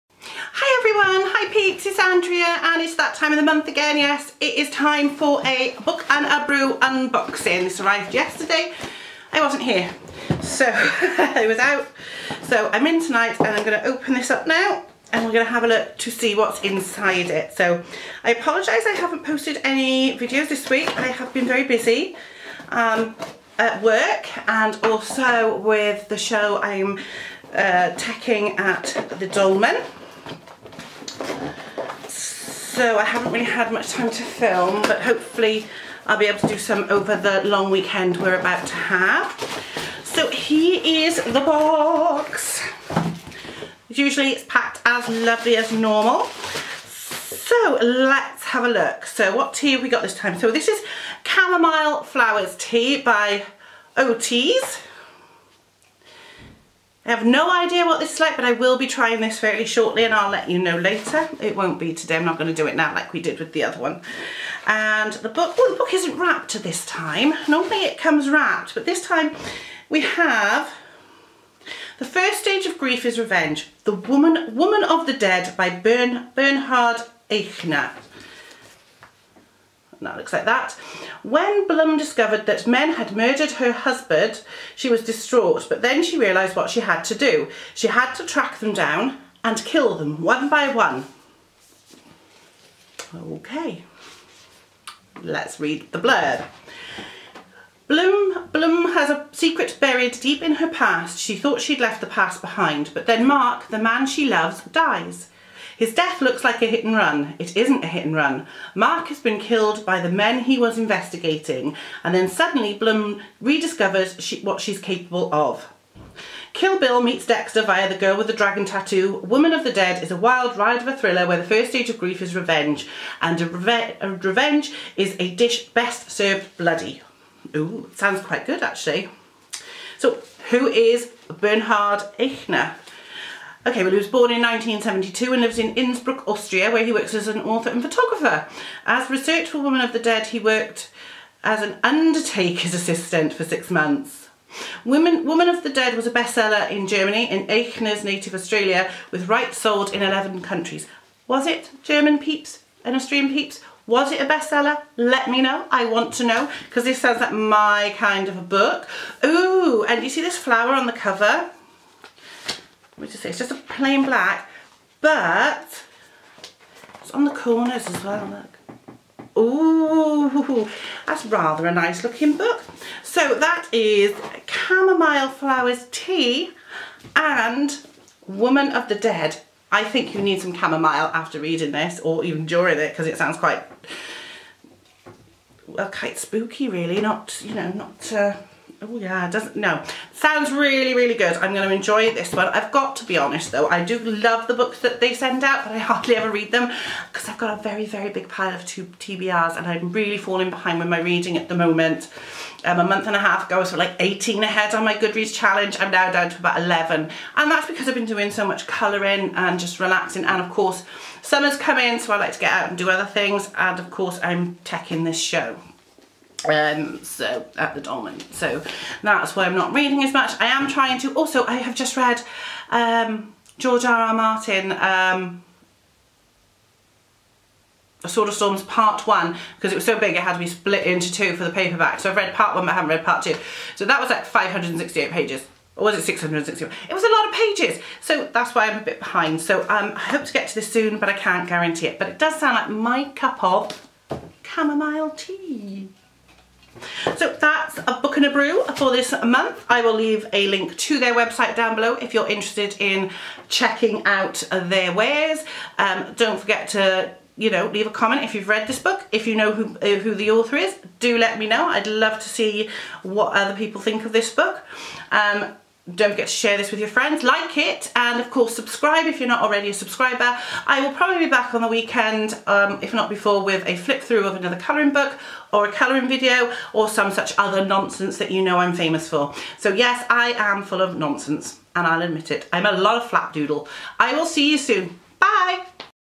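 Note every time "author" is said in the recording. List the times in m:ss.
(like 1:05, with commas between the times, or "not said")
2:17, 4:20.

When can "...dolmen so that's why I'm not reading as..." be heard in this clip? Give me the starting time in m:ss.
3:37.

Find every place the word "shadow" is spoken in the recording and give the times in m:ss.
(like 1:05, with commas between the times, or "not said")
not said.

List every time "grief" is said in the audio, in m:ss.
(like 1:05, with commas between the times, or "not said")
1:12, 2:01.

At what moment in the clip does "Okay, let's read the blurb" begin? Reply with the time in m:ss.
1:33.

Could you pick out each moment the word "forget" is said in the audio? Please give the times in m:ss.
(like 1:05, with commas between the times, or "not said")
4:16, 4:26.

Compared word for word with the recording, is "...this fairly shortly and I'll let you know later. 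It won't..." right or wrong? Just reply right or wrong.
right.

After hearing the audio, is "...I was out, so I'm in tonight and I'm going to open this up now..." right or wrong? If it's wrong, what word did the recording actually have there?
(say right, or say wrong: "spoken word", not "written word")
right.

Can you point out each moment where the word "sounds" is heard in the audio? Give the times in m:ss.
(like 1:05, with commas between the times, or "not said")
2:07, 2:36, 3:03, 3:10, 4:02.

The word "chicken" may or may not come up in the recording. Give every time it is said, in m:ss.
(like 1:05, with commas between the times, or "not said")
not said.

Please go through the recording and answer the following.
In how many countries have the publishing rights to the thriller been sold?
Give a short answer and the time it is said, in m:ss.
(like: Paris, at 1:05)
11, at 2:30.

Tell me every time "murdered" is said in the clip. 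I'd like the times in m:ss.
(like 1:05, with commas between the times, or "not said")
1:23.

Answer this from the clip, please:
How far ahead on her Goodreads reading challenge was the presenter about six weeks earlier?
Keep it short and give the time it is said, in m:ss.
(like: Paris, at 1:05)
18, at 3:23.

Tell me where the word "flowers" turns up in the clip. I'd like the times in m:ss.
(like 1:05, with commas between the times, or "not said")
0:52, 2:40, 2:55.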